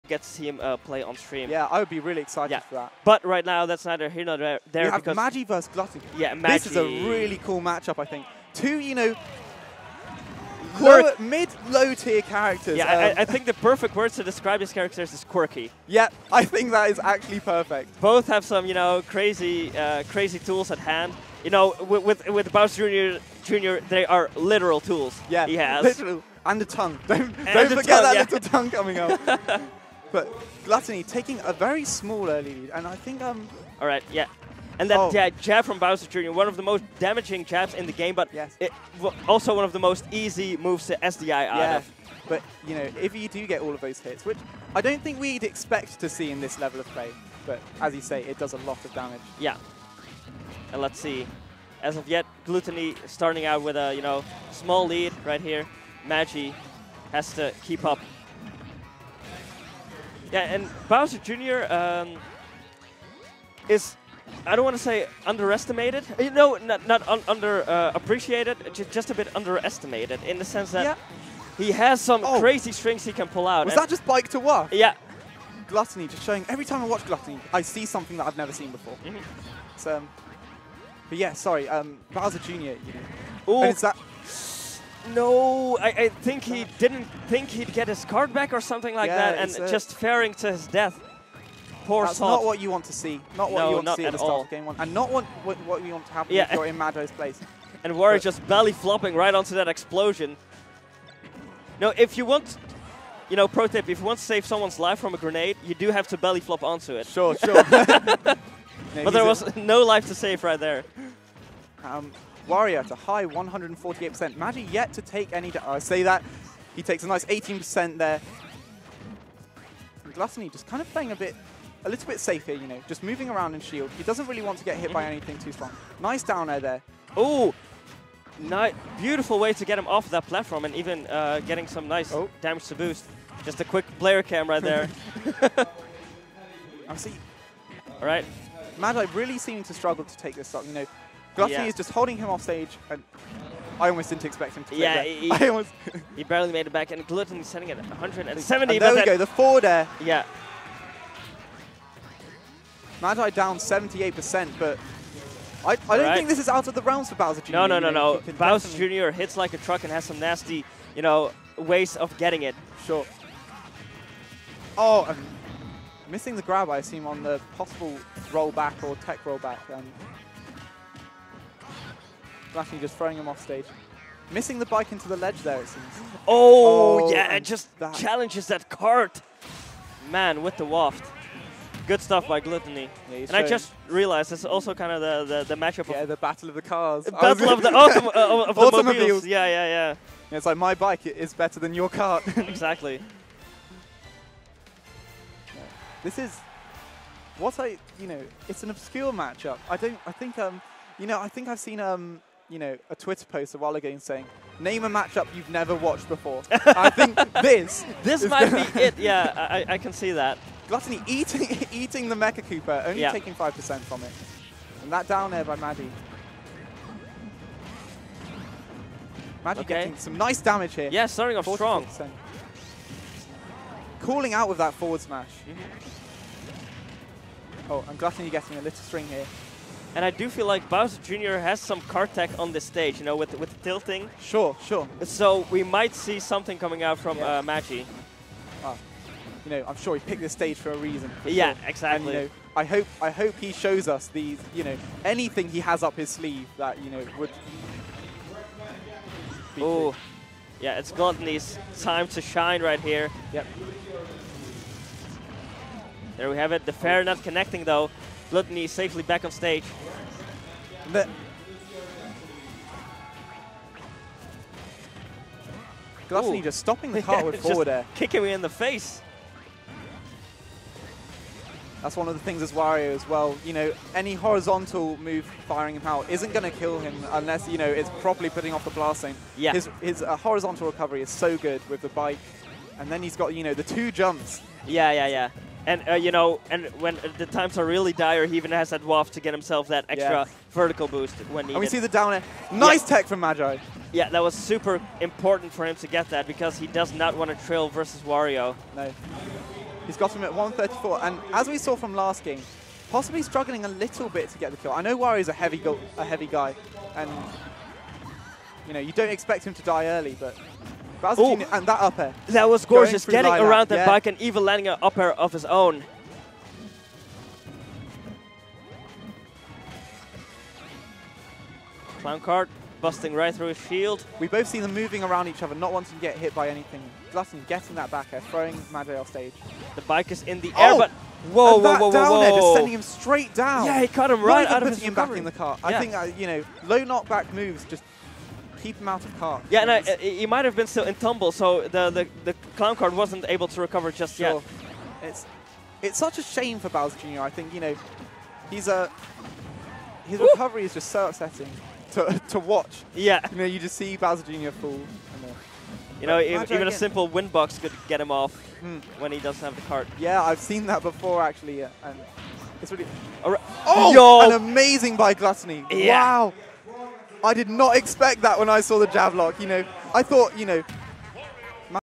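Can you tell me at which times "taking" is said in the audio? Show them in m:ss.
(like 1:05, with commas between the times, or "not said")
0:31, 3:33.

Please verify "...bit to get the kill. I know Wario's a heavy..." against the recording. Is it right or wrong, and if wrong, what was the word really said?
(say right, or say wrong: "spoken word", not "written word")
right.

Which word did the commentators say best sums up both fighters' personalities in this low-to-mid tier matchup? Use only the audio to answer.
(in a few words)
quirky.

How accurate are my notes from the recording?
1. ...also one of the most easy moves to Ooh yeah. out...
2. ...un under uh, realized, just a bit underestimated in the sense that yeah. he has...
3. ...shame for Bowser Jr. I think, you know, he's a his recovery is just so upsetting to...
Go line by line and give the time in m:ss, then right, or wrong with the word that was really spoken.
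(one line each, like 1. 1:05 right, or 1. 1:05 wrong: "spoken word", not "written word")
1. 0:39 wrong: "SDI", not "Ooh"
2. 1:07 wrong: "appreciated", not "realized"
3. 5:46 right.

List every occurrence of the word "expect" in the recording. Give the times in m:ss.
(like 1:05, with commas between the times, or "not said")
0:45, 2:24, 5:09, 6:07.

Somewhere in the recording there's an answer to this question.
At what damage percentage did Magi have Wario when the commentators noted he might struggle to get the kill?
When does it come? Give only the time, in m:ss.
5:00.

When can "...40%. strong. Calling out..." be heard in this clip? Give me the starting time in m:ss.
3:41.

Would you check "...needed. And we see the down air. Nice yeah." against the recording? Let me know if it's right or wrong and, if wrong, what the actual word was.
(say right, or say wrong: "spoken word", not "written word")
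right.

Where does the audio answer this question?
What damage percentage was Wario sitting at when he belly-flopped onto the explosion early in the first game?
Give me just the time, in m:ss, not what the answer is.
1:53.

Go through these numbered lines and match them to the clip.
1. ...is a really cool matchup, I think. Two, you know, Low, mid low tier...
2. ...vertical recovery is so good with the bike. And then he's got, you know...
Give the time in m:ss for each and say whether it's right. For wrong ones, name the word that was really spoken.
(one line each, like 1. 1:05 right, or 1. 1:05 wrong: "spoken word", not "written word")
1. 0:06 right
2. 4:40 wrong: "horizontal", not "vertical".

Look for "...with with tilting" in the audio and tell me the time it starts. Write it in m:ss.
3:53.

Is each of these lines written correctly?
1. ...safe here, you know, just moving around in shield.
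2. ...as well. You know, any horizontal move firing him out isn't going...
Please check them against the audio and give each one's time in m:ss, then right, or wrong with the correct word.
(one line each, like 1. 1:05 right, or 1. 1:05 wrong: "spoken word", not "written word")
1. 2:02 right
2. 4:32 right.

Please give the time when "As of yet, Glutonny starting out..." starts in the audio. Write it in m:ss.
0:51.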